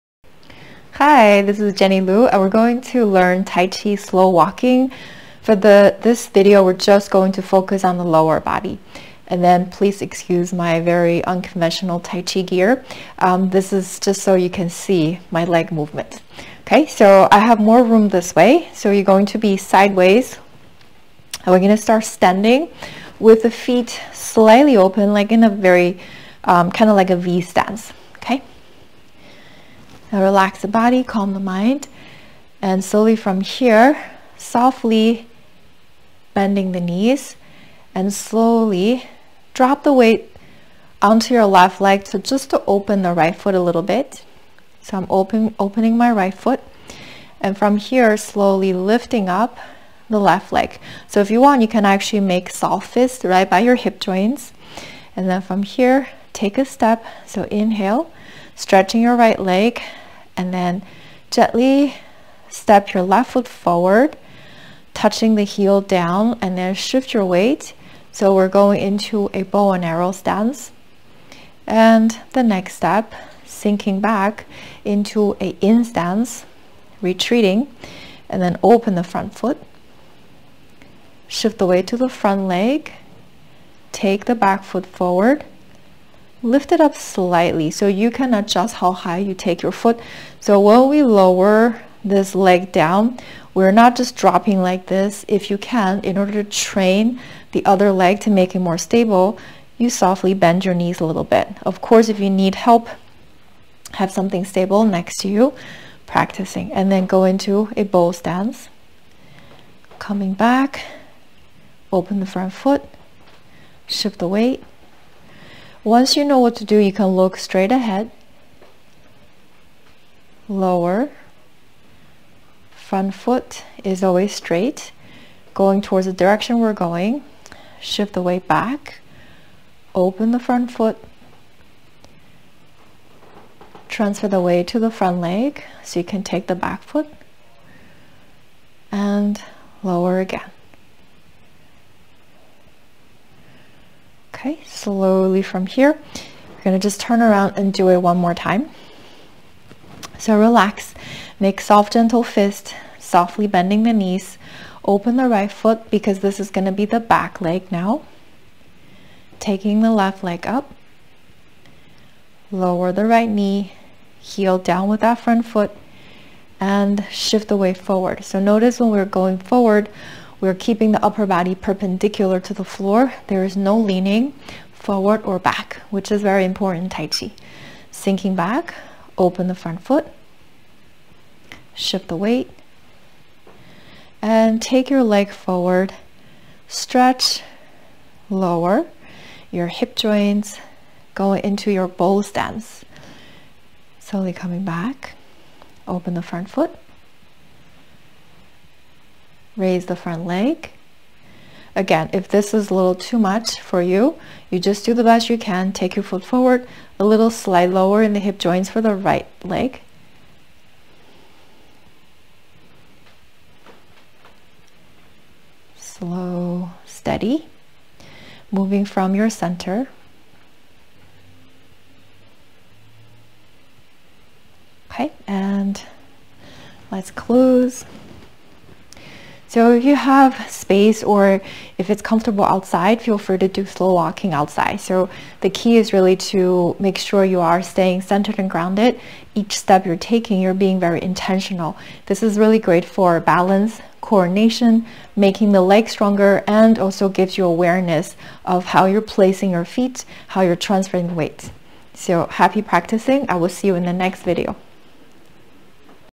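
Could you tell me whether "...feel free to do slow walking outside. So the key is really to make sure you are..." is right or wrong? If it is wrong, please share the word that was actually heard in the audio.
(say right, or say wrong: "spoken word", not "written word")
right.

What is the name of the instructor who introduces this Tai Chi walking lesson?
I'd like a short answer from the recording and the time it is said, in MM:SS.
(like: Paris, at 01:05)
Jenny Lu, at 00:01.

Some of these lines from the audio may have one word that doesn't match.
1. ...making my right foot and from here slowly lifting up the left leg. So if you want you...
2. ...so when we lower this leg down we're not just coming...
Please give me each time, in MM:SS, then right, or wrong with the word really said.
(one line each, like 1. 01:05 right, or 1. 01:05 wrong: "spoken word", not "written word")
1. 00:45 wrong: "opening", not "making"
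2. 01:30 wrong: "dropping", not "coming".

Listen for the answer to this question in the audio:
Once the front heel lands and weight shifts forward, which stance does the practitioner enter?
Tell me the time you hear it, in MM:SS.
01:09.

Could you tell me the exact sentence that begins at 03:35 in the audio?
Slow, steady, moving from your center.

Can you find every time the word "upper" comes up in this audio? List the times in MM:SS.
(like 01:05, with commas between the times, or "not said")
02:51.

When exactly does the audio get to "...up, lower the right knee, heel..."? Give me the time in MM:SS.
02:40.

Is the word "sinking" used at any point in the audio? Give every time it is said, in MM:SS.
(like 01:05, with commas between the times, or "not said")
01:13, 02:57.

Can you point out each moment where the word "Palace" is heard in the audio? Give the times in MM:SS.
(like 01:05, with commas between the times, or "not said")
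not said.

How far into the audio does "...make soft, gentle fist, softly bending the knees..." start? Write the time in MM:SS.
02:31.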